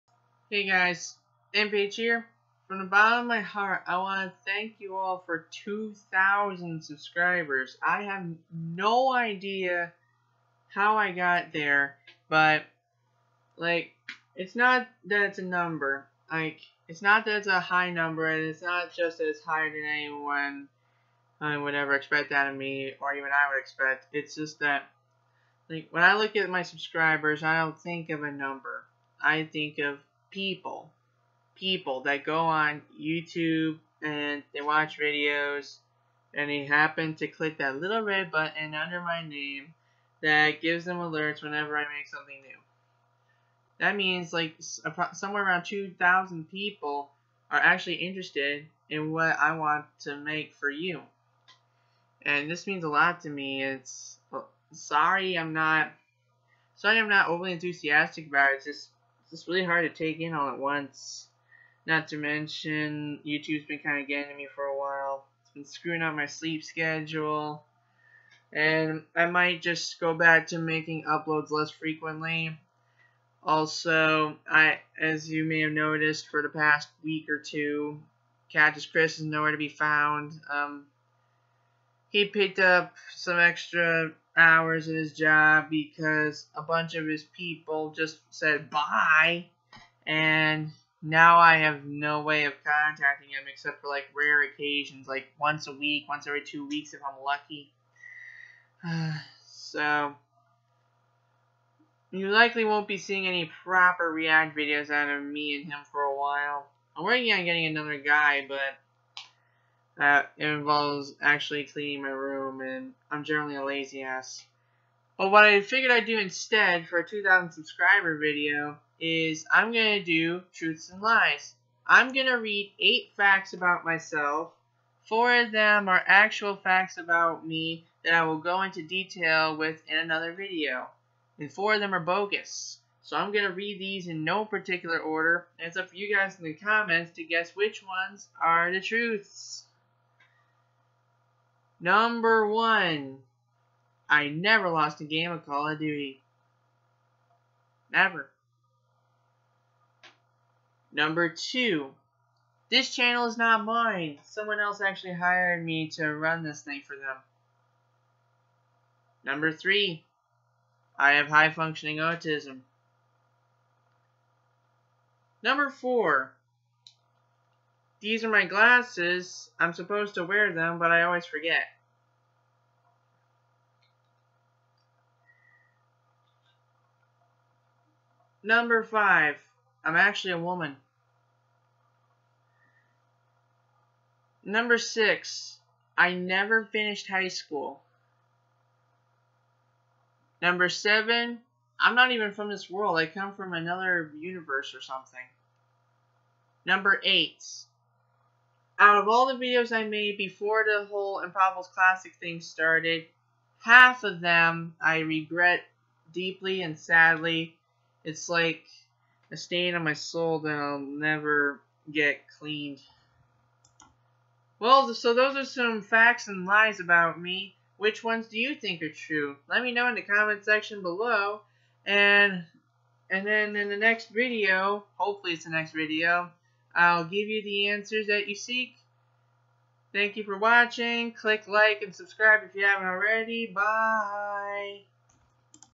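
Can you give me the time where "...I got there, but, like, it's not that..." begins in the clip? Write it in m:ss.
0:10.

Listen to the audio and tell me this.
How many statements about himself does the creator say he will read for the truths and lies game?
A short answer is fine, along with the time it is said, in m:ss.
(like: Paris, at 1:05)
8, at 2:02.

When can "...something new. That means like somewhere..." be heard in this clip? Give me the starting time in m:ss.
0:42.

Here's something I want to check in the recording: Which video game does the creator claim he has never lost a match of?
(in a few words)
Call of Duty.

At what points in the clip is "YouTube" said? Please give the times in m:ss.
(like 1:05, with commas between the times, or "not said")
0:32, 1:03.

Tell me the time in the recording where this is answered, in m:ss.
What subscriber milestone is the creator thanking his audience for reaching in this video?
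0:05.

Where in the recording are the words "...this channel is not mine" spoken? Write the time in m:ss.
2:32.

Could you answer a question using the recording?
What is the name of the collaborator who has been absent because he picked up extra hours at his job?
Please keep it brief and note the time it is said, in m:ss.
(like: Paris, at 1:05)
Cactus Chris, at 1:18.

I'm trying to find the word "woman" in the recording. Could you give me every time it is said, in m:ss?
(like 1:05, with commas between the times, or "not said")
3:00.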